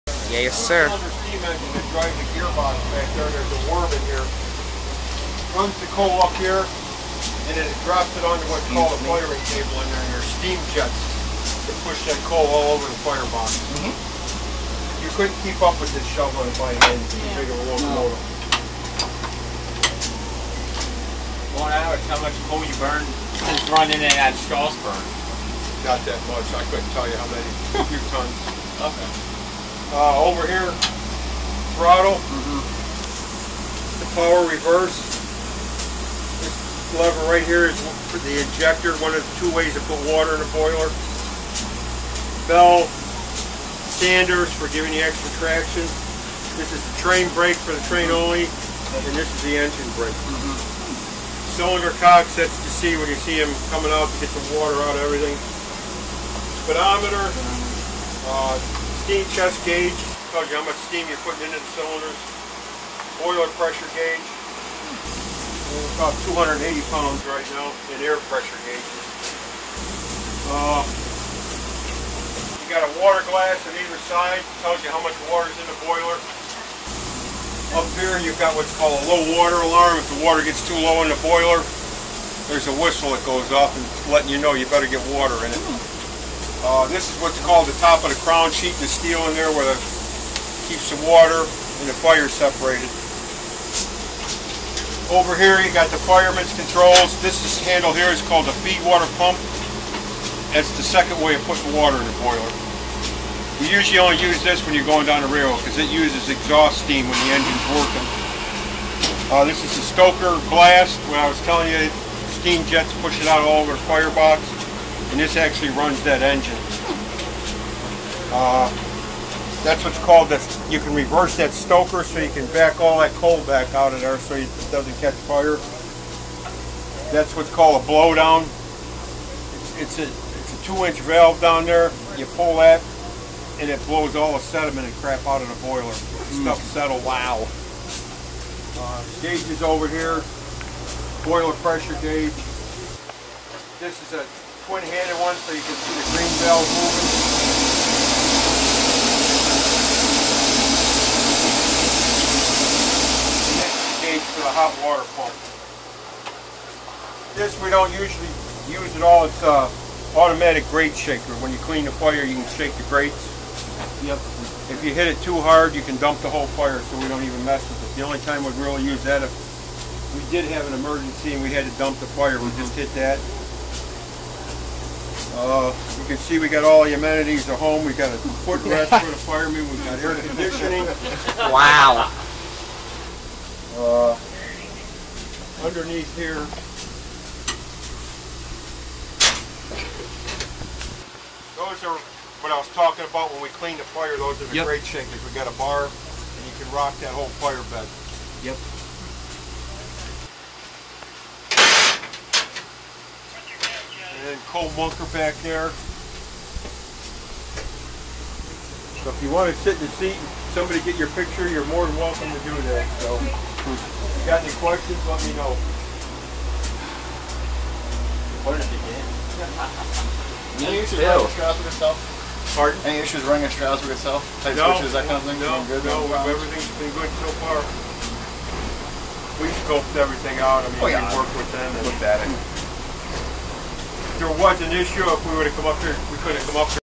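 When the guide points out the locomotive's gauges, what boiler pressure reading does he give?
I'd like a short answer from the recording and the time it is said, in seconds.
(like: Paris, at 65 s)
280 pounds, at 66 s.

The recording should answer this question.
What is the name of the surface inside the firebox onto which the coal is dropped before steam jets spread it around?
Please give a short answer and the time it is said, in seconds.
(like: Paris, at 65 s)
firing table, at 9 s.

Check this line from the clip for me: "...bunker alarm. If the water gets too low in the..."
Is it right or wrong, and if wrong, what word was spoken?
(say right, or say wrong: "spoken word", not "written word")
wrong: "water", not "bunker".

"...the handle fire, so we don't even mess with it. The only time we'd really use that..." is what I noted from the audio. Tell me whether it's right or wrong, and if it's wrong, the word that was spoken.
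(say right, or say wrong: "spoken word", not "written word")
wrong: "whole", not "handle".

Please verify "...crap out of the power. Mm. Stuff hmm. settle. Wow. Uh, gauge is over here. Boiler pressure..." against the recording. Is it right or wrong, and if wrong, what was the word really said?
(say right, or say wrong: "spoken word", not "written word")
wrong: "boiler", not "power".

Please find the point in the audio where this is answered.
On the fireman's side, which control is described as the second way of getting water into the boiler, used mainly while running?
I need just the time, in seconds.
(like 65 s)
98 s.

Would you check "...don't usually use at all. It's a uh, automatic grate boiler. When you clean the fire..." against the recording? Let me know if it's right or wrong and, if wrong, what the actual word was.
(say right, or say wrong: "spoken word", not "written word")
wrong: "shaker", not "boiler".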